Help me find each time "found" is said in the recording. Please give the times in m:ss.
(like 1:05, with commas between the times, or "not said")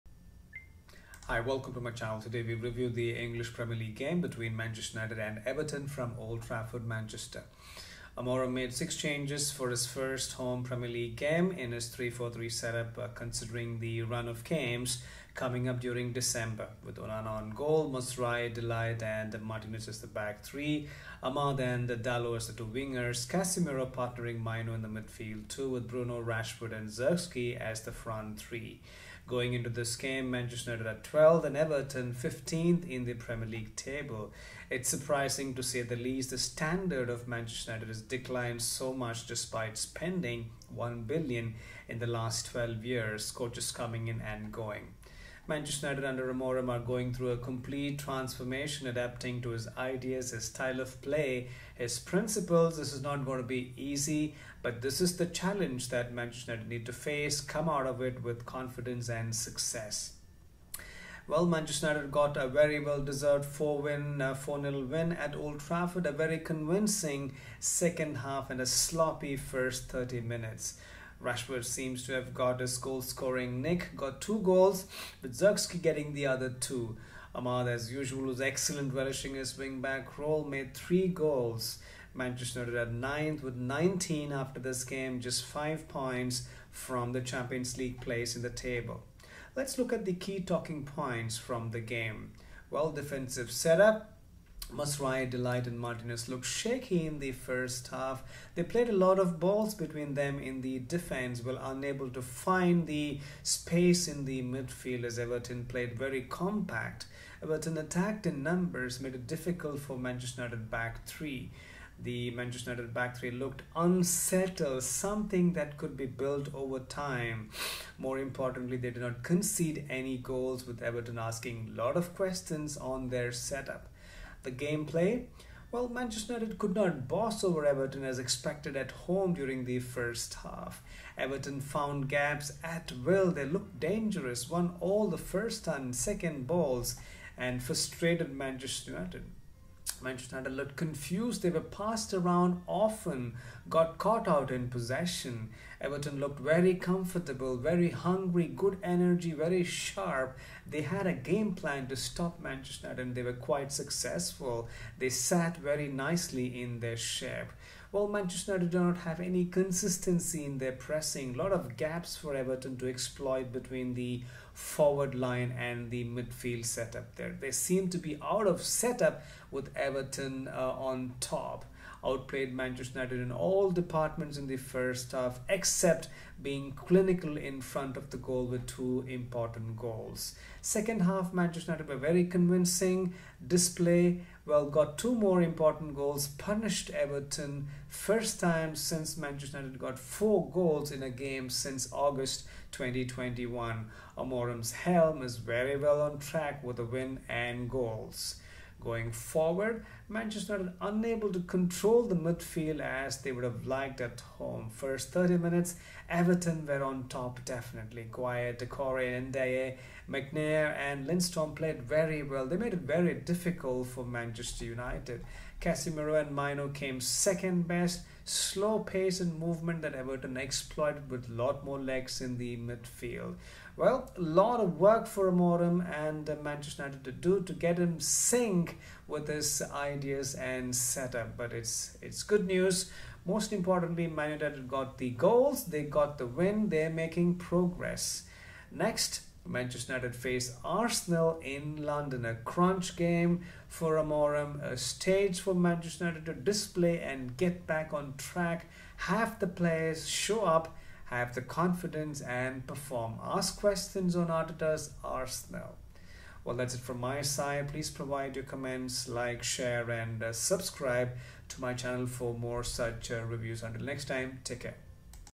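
2:11.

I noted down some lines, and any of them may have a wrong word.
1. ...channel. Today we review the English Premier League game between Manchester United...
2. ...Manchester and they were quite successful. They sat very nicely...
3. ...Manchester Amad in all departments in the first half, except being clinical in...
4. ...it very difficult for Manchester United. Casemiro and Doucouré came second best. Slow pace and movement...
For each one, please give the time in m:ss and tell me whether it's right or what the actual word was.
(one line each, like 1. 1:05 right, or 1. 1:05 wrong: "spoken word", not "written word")
1. 0:01 right
2. 2:32 right
3. 2:52 wrong: "United", not "Amad"
4. 3:32 wrong: "Mainoo", not "Doucouré".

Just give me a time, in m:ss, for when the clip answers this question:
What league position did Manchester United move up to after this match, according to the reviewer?
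1:22.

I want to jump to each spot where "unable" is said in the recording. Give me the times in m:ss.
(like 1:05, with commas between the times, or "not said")
1:41, 3:20.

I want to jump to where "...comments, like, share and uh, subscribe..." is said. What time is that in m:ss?
4:18.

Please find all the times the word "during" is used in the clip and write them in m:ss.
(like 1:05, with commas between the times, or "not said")
0:15, 2:09.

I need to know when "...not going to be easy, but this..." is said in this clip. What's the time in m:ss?
0:53.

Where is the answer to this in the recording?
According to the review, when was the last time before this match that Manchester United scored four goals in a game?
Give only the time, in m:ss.
3:11.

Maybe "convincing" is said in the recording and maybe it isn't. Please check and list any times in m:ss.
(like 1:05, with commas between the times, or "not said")
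1:06, 3:02.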